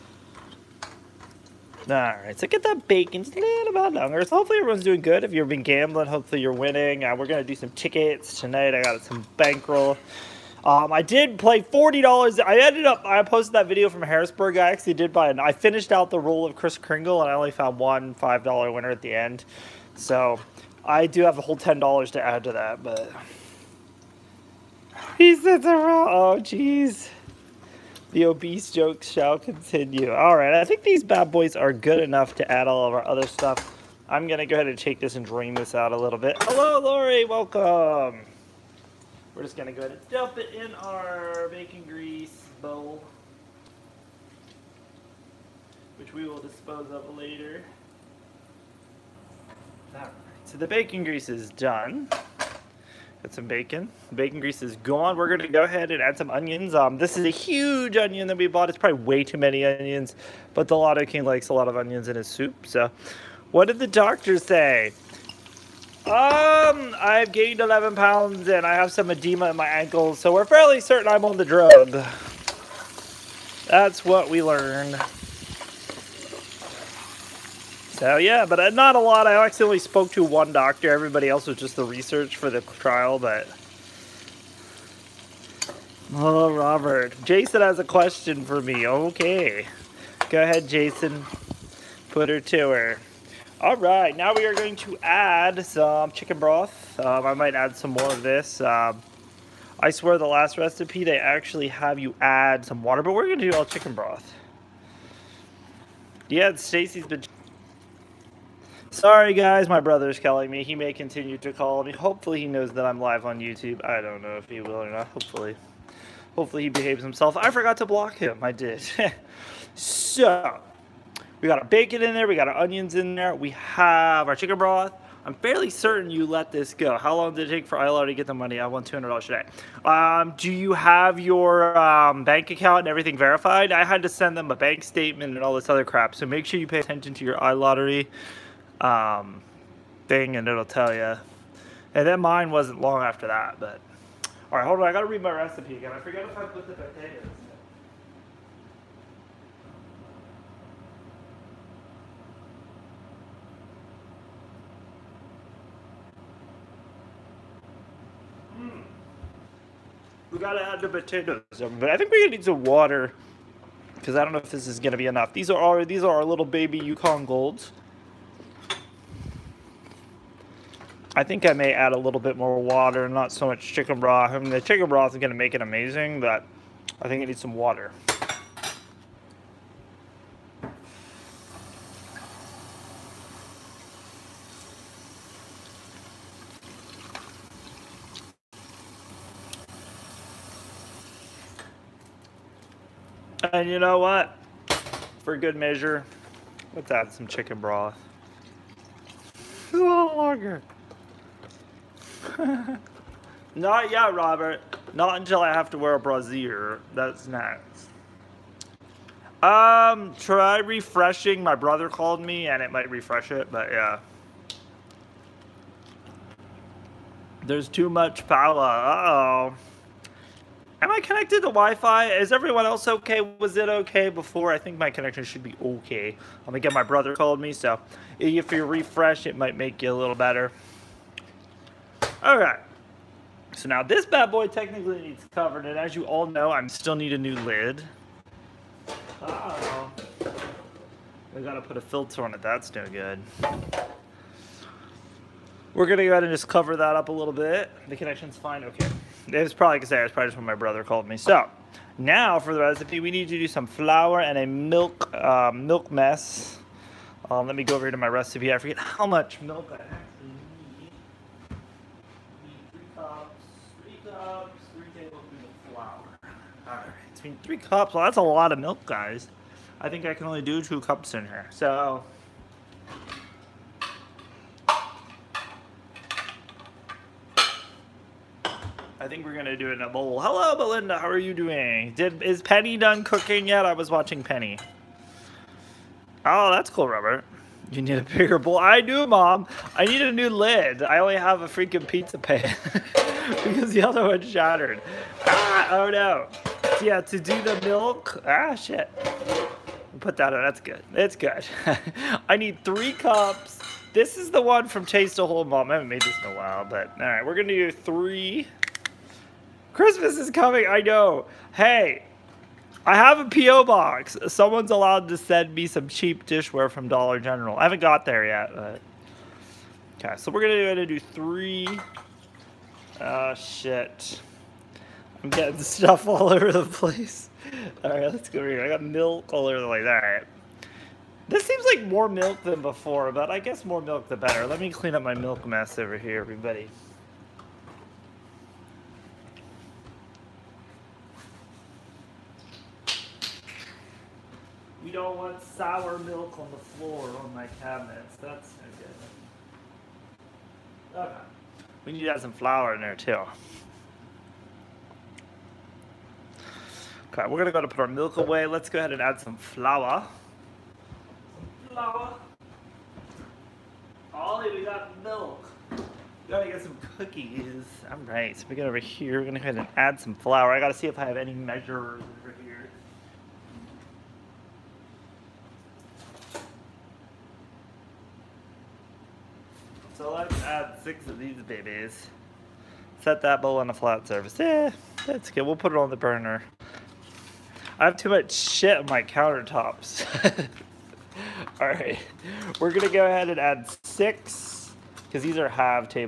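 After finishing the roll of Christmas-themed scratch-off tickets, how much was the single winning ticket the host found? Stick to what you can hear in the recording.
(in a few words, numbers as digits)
$5.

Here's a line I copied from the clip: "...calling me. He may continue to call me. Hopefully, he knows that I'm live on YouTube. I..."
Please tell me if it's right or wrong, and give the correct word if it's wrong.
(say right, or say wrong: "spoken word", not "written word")
right.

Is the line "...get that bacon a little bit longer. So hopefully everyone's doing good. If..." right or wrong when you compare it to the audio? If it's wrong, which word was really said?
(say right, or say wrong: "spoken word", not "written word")
right.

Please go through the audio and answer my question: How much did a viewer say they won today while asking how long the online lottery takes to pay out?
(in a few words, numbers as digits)
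$200.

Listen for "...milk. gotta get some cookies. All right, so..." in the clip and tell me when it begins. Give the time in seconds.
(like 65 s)
365 s.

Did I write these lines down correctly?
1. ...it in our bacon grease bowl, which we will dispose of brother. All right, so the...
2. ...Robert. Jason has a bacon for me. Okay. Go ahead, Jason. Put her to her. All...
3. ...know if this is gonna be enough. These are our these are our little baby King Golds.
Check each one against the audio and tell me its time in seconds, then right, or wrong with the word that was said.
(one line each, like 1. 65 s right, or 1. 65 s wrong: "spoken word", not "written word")
1. 40 s wrong: "later", not "brother"
2. 86 s wrong: "question", not "bacon"
3. 164 s wrong: "Yukon", not "King".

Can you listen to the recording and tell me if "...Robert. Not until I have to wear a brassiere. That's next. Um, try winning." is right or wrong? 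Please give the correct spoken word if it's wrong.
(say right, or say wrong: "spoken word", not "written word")
wrong: "refreshing", not "winning".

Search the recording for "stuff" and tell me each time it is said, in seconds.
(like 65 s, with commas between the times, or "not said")
33 s, 325 s.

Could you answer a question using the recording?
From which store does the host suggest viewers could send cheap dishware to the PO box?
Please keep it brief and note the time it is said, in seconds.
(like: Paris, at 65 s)
Dollar General, at 316 s.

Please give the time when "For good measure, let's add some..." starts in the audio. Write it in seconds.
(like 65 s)
195 s.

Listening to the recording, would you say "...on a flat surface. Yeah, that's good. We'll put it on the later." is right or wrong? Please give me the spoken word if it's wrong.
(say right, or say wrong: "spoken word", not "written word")
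wrong: "burner", not "later".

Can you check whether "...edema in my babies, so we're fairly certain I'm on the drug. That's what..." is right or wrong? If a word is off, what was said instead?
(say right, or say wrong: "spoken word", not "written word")
wrong: "ankles", not "babies".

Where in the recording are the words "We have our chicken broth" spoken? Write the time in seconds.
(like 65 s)
123 s.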